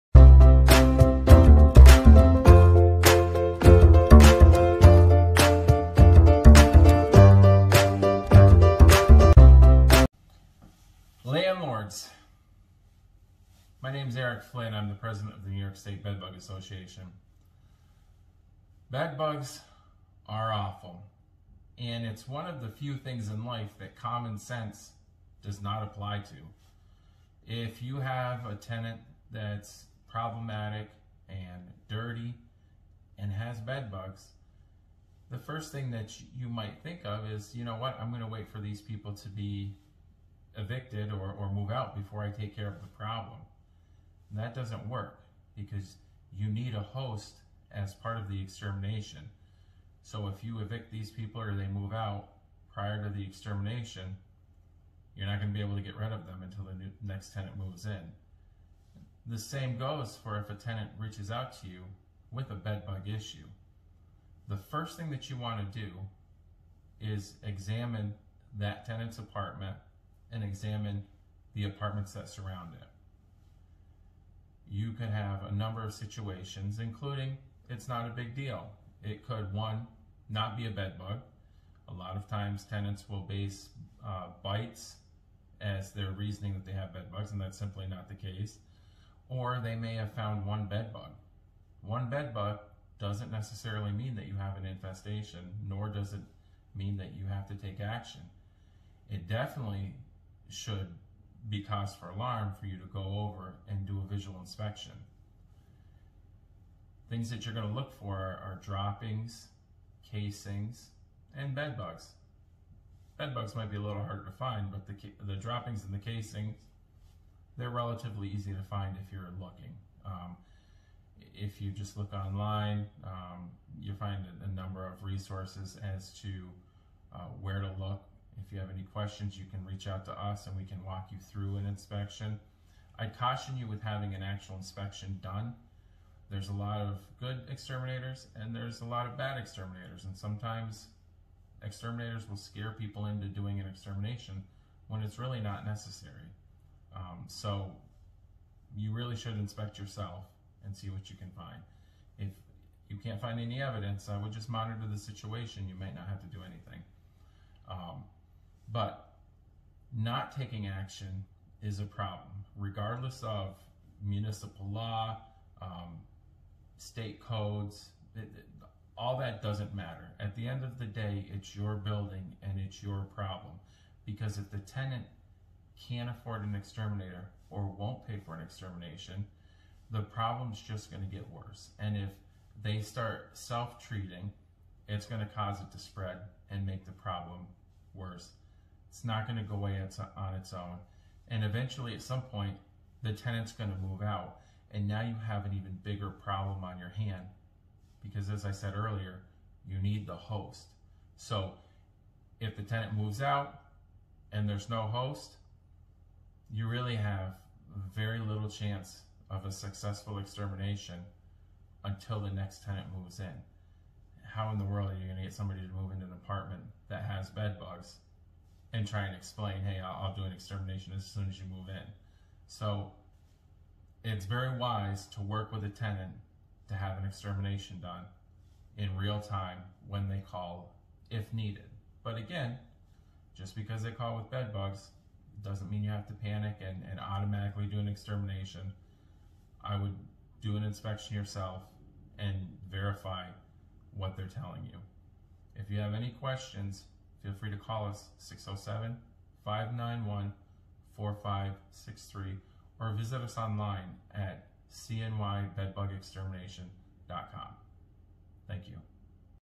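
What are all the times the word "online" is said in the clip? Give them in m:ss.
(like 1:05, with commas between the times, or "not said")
2:02, 4:13.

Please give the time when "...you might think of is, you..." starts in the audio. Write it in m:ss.
0:36.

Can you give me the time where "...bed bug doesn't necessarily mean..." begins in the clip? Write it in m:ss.
1:32.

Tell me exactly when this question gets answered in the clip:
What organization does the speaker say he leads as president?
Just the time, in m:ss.
0:15.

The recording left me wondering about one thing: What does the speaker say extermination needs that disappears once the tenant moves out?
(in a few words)
A host.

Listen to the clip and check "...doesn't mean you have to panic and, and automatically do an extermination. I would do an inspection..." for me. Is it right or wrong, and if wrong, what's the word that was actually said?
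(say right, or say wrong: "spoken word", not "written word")
right.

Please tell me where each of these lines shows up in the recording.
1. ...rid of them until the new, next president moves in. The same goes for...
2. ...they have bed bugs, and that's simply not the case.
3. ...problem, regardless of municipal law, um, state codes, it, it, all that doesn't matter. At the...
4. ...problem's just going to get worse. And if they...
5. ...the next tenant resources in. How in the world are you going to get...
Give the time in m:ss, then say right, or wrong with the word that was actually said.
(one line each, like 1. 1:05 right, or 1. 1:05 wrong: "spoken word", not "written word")
1. 0:55 wrong: "tenant", not "president"
2. 1:26 right
3. 2:41 right
4. 3:00 right
5. 3:32 wrong: "moves", not "resources".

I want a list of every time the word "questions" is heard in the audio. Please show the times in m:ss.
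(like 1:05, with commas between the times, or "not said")
2:08, 4:06.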